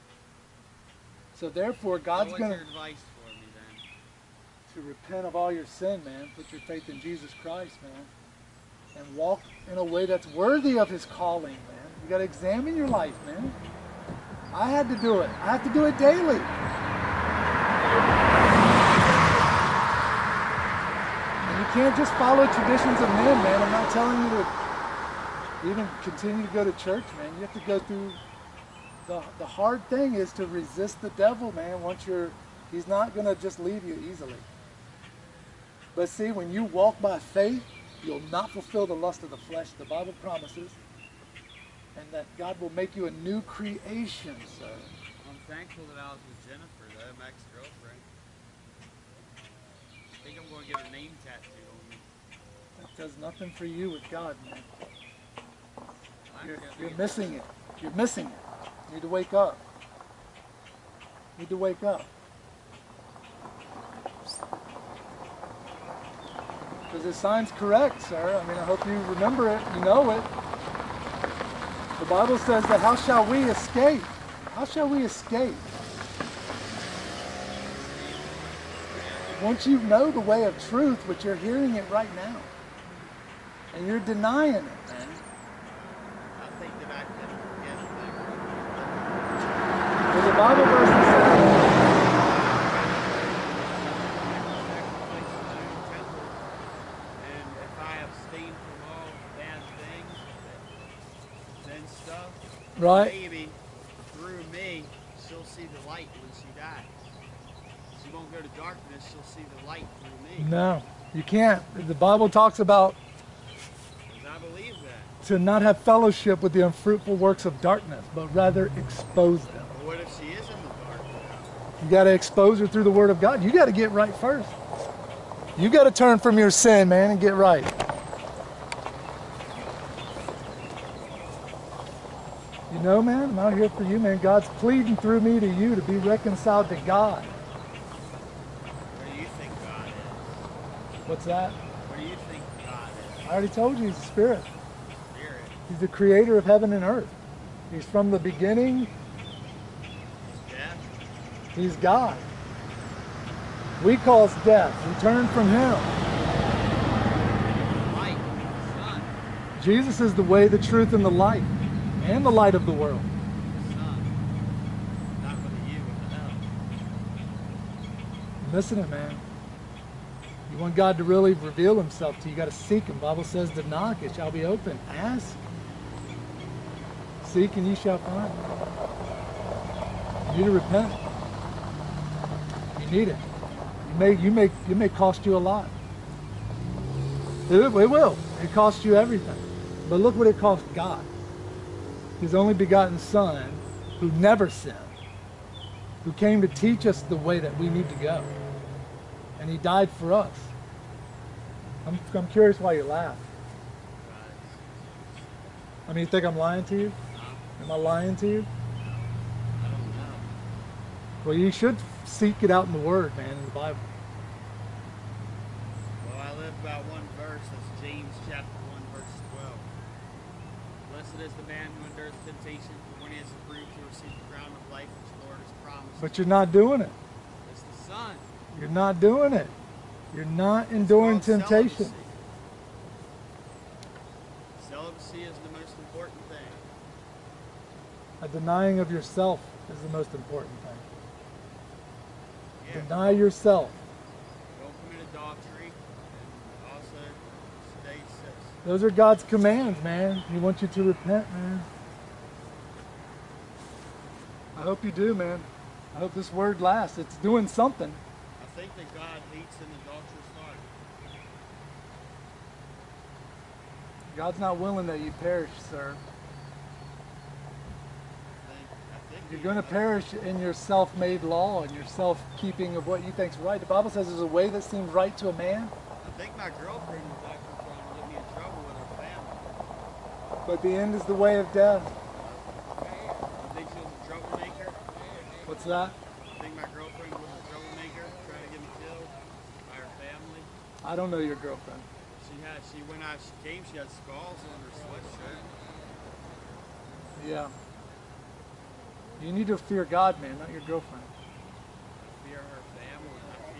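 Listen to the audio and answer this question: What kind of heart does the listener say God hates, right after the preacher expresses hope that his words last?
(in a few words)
adulterous.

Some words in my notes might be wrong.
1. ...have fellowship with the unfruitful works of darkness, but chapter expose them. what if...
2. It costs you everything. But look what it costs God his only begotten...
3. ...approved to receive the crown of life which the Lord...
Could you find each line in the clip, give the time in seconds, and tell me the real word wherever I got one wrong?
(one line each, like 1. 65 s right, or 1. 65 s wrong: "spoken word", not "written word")
1. 115 s wrong: "rather", not "chapter"
2. 188 s right
3. 223 s right.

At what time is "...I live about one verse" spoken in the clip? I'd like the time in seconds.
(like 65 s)
216 s.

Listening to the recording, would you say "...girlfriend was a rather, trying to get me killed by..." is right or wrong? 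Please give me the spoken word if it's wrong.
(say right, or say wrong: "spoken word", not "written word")
wrong: "troublemaker", not "rather".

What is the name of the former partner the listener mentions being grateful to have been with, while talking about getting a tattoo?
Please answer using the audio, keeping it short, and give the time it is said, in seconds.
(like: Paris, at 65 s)
Jennifer, at 46 s.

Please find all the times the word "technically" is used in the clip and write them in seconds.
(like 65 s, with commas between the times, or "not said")
not said.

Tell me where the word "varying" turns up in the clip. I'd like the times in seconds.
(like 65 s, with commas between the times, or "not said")
not said.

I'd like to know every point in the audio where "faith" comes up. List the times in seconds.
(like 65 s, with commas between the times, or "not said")
6 s, 37 s.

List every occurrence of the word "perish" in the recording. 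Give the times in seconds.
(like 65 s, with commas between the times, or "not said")
265 s, 269 s.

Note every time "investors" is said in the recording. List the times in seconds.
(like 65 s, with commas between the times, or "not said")
not said.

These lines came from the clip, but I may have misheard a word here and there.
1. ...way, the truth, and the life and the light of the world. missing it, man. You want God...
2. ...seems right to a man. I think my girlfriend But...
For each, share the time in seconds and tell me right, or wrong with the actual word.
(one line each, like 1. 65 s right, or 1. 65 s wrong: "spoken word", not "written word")
1. 160 s right
2. 274 s right.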